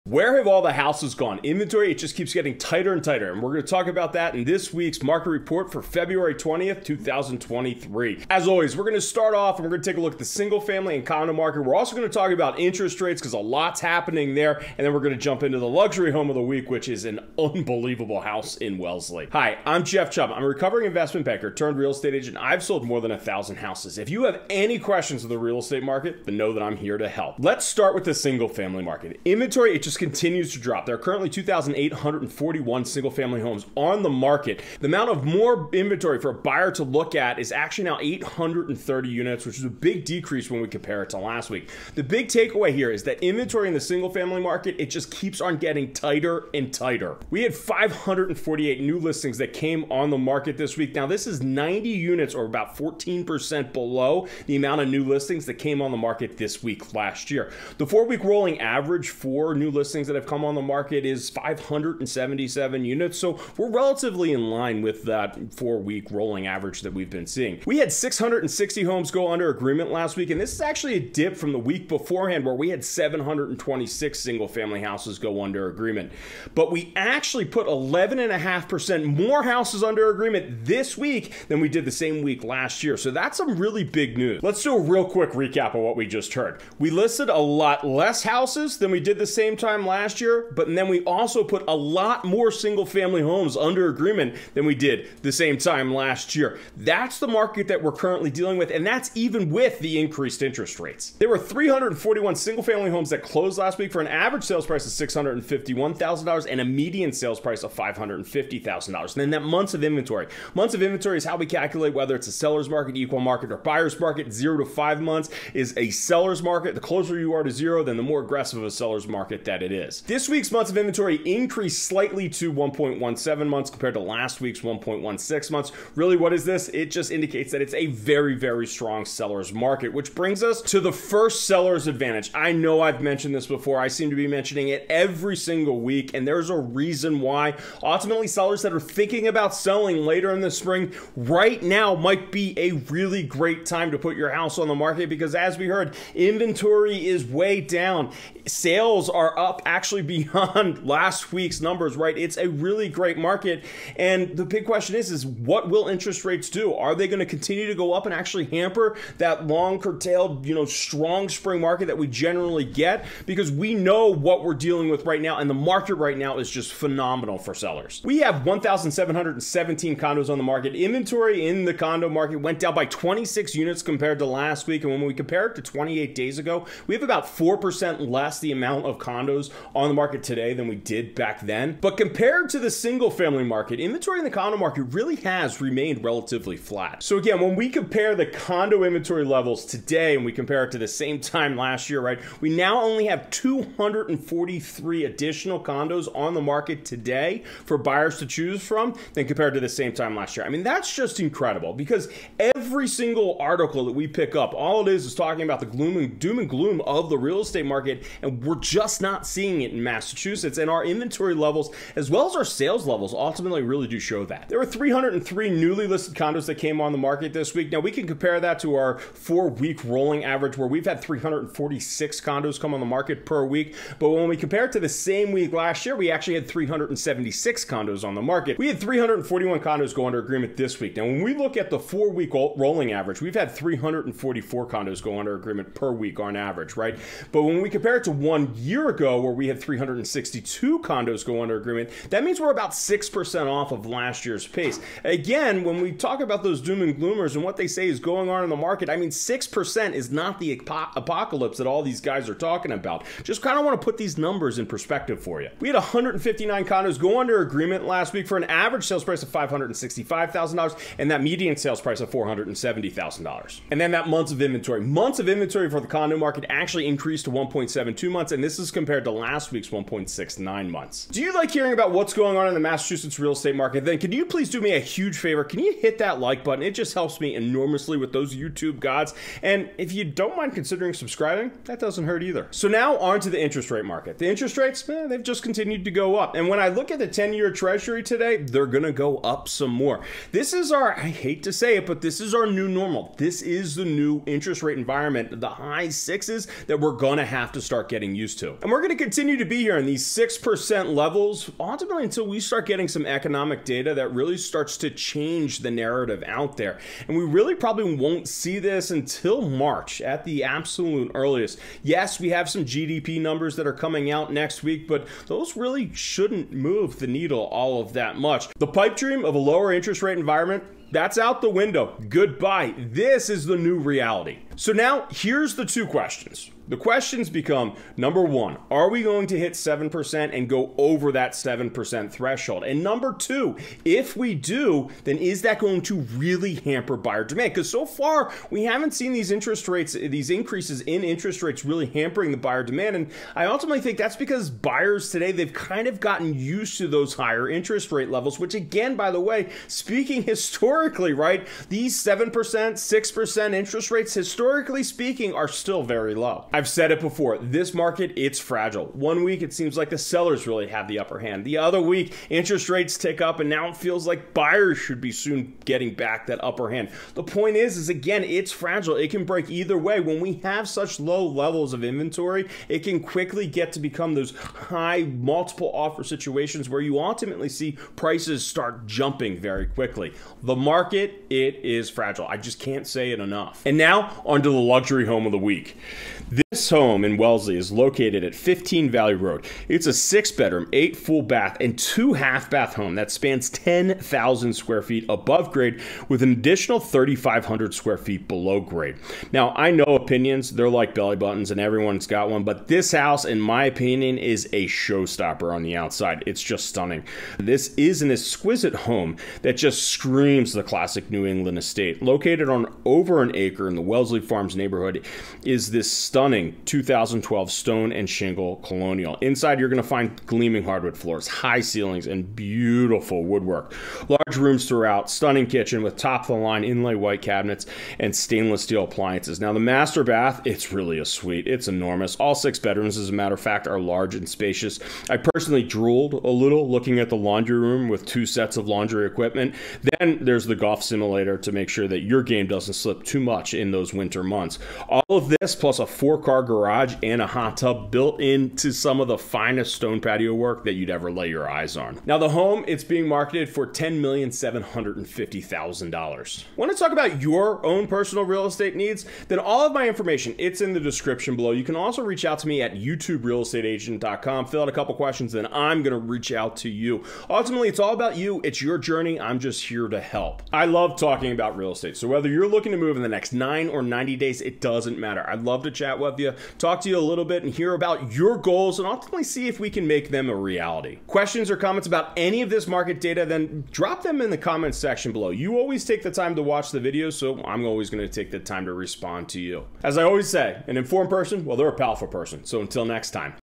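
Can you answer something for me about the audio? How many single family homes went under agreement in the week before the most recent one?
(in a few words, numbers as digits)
726.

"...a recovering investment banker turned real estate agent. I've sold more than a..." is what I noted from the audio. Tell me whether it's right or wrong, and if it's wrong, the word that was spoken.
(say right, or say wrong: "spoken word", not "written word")
right.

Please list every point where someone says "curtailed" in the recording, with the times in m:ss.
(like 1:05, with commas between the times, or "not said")
2:39.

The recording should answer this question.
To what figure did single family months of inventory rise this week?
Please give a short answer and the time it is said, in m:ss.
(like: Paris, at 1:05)
1.17 months, at 2:02.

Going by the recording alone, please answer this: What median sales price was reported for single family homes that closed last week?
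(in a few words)
$550,000.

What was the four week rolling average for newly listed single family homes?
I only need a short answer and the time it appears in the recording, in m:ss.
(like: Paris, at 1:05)
577 units, at 1:01.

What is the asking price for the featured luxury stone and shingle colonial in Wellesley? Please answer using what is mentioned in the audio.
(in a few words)
$10,750,000.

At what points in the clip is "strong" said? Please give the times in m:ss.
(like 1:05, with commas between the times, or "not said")
2:08, 2:40.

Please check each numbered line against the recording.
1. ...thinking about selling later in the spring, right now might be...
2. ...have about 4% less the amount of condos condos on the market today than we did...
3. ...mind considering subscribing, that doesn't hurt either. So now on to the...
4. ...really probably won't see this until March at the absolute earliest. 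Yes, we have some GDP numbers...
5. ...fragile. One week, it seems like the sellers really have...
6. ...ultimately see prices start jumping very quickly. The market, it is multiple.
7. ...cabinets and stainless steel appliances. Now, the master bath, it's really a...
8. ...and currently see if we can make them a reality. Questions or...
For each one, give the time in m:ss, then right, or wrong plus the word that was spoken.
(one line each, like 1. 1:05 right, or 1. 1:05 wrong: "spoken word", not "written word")
1. 2:18 right
2. 2:56 right
3. 4:40 right
4. 5:07 right
5. 5:58 right
6. 6:16 wrong: "fragile", not "multiple"
7. 7:07 right
8. 7:58 wrong: "ultimately", not "currently".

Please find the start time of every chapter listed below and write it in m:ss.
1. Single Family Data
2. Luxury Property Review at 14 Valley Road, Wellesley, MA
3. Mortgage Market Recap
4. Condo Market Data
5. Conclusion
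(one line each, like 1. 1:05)
1. 0:27
2. 6:23
3. 4:41
4. 2:47
5. 7:35.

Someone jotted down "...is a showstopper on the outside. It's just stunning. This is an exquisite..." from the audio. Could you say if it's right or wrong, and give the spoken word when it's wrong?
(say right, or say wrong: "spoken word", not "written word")
right.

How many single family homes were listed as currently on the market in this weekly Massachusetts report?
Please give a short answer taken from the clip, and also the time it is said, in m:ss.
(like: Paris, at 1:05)
2,841, at 0:31.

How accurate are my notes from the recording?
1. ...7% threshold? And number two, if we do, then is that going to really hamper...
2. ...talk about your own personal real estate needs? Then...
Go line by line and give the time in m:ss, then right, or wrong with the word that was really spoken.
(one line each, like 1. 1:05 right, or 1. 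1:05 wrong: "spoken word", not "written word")
1. 5:31 right
2. 7:36 right.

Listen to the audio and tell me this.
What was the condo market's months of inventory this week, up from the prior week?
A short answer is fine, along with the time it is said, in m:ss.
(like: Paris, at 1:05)
1.72 months, at 4:27.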